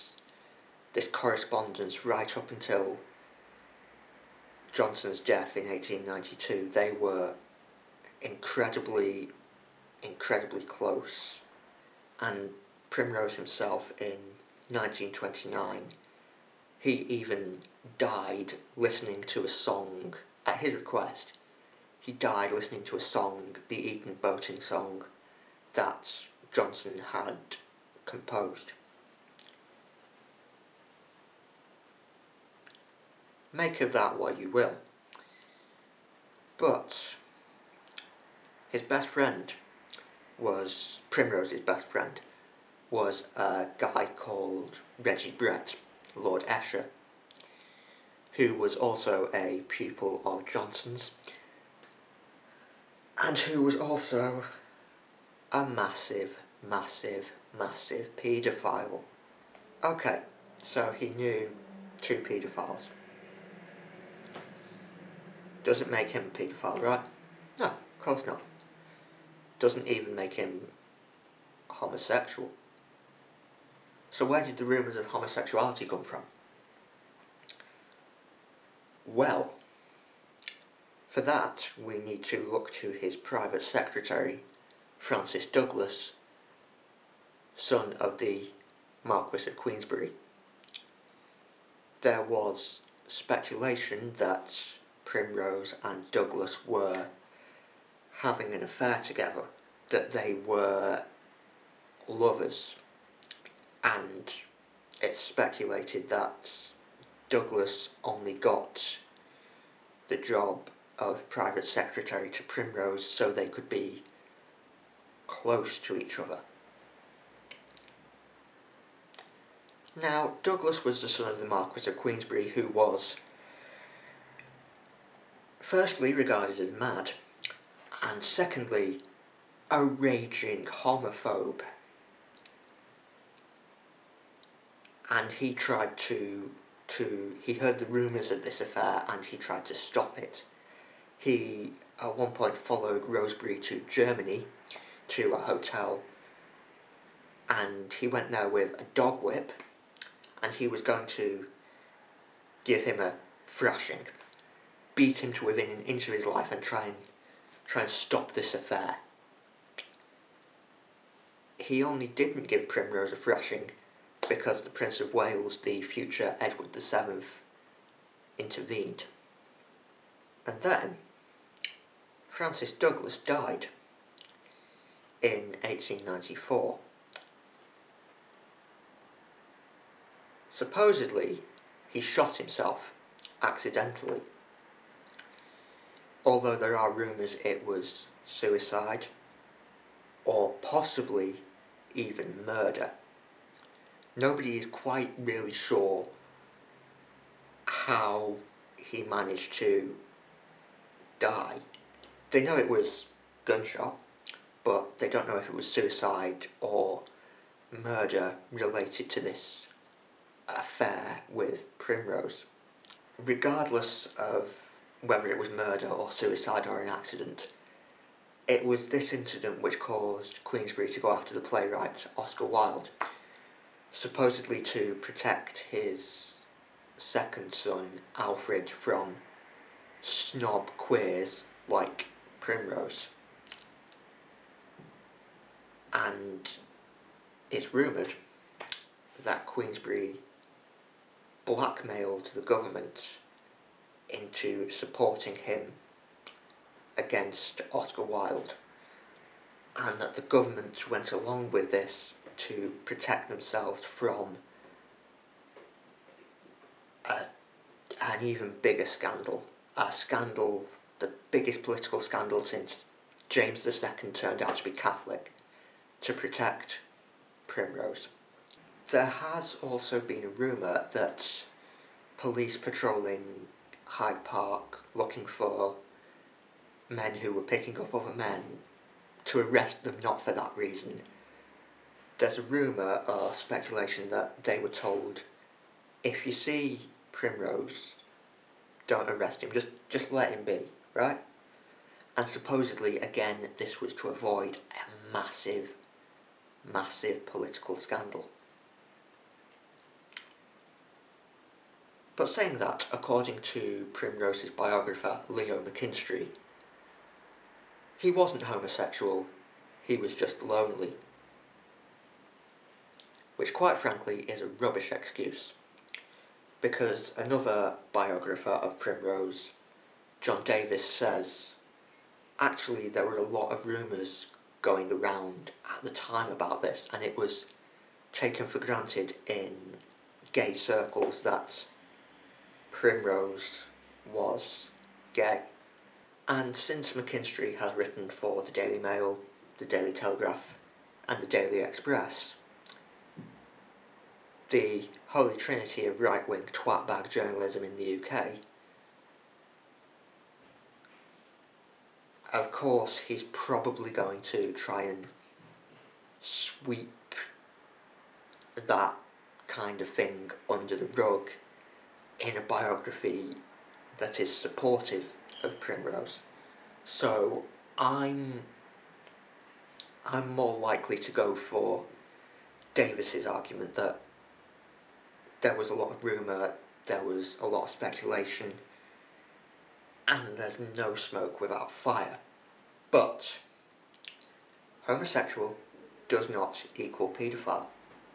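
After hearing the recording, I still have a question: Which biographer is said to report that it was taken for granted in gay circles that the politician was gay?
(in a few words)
John Davis.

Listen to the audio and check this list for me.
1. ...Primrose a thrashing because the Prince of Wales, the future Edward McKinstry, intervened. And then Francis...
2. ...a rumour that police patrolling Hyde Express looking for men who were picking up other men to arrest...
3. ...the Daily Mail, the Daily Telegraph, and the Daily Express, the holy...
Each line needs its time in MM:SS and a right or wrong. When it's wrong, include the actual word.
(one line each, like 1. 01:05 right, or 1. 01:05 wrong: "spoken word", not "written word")
1. 02:42 wrong: "VII", not "McKinstry"
2. 04:30 wrong: "Park", not "Express"
3. 05:38 right.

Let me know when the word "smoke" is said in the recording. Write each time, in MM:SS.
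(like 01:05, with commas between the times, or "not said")
06:20.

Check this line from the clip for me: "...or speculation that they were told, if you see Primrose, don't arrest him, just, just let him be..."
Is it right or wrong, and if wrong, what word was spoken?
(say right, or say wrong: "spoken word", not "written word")
right.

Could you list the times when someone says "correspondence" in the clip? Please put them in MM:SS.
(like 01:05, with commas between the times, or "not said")
00:01.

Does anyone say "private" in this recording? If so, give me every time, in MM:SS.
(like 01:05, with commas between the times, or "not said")
01:23, 01:51.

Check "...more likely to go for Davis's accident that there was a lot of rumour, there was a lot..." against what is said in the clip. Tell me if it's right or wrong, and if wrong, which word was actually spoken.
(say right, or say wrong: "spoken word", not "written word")
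wrong: "argument", not "accident".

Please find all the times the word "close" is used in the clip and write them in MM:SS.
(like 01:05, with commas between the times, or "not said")
00:10, 01:55.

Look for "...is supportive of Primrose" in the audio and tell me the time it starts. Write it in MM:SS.
06:04.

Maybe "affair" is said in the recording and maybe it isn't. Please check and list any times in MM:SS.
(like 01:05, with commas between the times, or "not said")
01:38, 02:18, 02:38, 03:30.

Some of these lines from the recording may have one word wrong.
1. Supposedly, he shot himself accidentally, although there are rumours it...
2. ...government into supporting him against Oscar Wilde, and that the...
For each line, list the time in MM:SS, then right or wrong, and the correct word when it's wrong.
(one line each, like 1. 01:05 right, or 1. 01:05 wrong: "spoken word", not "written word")
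1. 03:00 right
2. 04:02 right.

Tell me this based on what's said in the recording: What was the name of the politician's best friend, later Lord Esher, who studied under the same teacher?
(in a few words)
Reggie Brett.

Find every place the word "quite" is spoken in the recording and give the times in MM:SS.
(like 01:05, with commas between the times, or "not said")
03:14, 05:13.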